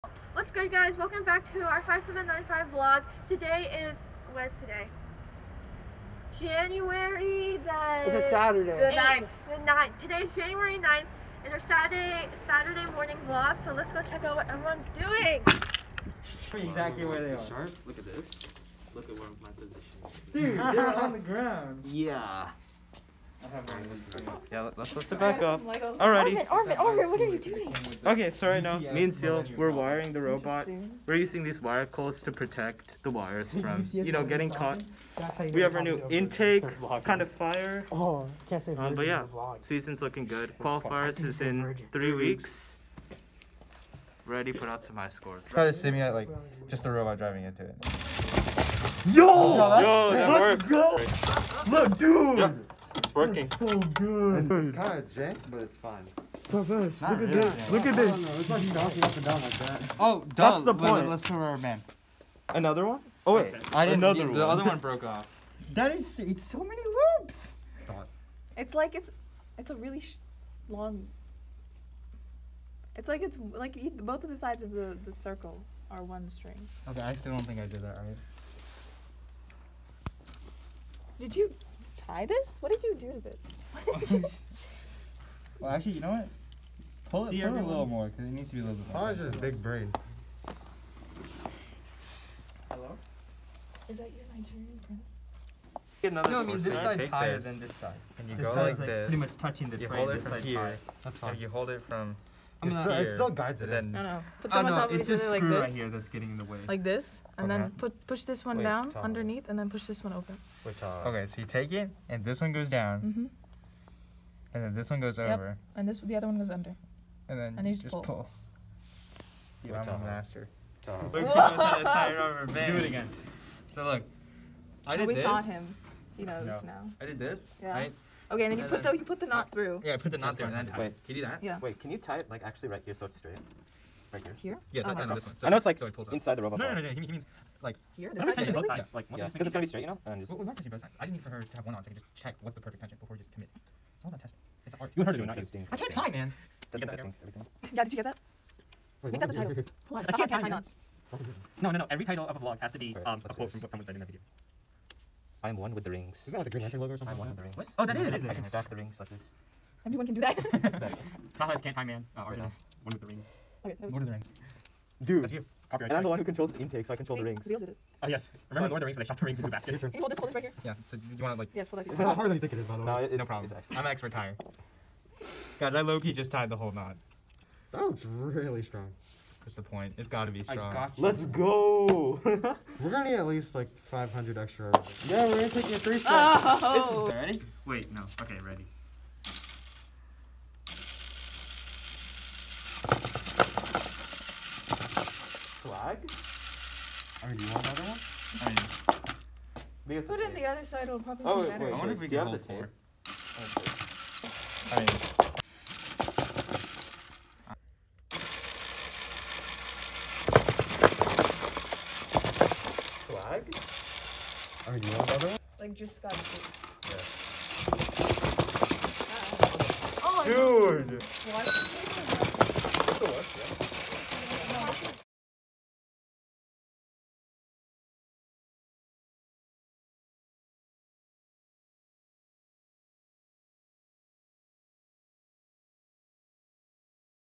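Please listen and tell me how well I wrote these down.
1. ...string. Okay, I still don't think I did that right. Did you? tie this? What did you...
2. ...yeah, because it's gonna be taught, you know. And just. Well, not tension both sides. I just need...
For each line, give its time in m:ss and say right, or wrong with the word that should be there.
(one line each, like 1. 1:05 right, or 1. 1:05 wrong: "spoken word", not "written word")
1. 1:16 right
2. 2:19 wrong: "straight", not "taught".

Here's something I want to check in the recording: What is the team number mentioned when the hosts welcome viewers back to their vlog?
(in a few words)
5795.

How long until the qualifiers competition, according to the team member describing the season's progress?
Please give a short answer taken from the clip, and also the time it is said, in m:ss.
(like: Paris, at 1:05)
3 weeks, at 0:41.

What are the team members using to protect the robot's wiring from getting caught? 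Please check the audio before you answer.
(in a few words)
wire coils.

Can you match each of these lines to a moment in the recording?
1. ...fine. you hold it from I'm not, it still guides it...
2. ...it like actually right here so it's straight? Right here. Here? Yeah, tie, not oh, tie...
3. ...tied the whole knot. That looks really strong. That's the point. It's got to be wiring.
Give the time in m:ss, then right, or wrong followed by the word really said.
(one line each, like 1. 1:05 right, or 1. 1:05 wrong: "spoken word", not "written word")
1. 1:41 right
2. 2:12 right
3. 2:56 wrong: "strong", not "wiring".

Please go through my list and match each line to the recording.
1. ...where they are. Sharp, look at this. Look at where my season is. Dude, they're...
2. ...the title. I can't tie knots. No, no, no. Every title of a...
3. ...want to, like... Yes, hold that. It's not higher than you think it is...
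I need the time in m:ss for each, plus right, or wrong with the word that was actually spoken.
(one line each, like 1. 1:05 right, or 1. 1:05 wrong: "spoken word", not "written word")
1. 0:17 wrong: "position", not "season"
2. 2:29 right
3. 2:51 wrong: "harder", not "higher".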